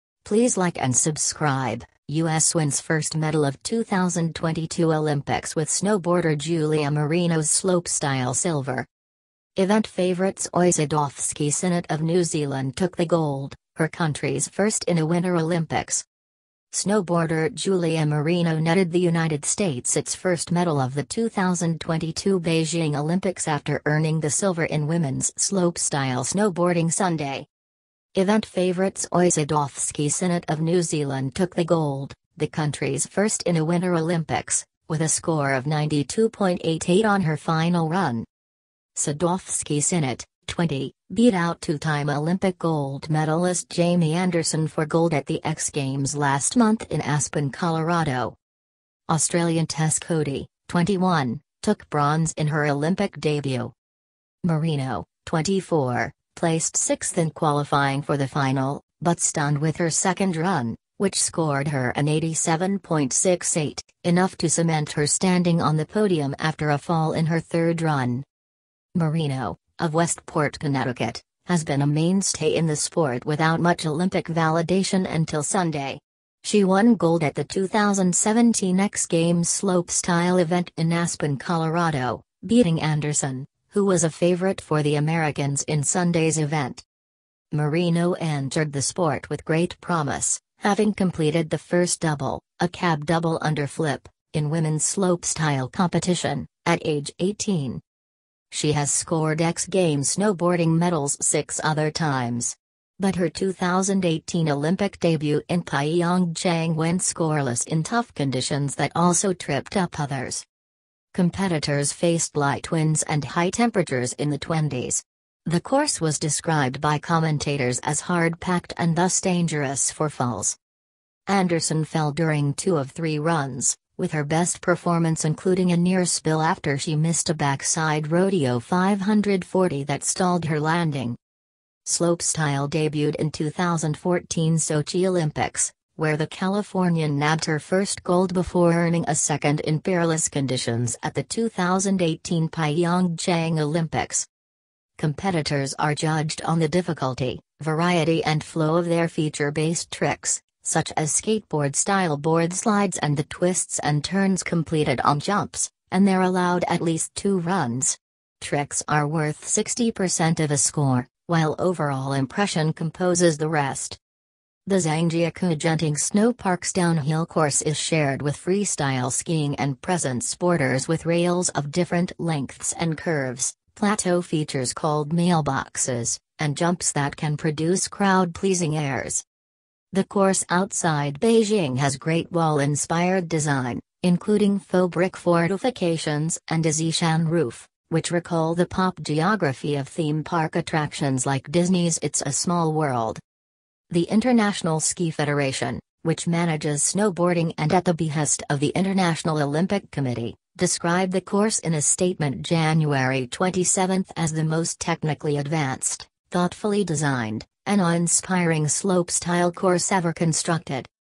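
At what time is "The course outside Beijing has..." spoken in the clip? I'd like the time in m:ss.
2:59.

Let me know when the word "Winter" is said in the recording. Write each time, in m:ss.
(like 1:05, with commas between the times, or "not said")
0:15, 0:33.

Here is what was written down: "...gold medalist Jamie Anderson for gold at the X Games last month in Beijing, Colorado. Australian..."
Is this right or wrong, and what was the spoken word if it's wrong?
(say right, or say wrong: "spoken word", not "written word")
wrong: "Aspen", not "Beijing".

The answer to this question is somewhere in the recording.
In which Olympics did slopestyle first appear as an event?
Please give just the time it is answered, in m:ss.
2:13.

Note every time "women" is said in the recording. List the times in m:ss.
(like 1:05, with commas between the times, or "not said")
0:24, 1:34.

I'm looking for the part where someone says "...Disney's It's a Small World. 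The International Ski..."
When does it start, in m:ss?
3:11.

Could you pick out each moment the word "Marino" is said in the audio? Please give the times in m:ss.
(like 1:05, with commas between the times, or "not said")
0:06, 0:18, 0:54, 1:08, 1:27.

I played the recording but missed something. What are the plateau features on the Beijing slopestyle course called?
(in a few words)
mailboxes.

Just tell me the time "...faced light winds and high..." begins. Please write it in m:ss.
1:51.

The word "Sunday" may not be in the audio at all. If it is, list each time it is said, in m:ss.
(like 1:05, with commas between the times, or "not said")
0:26, 1:15, 1:25.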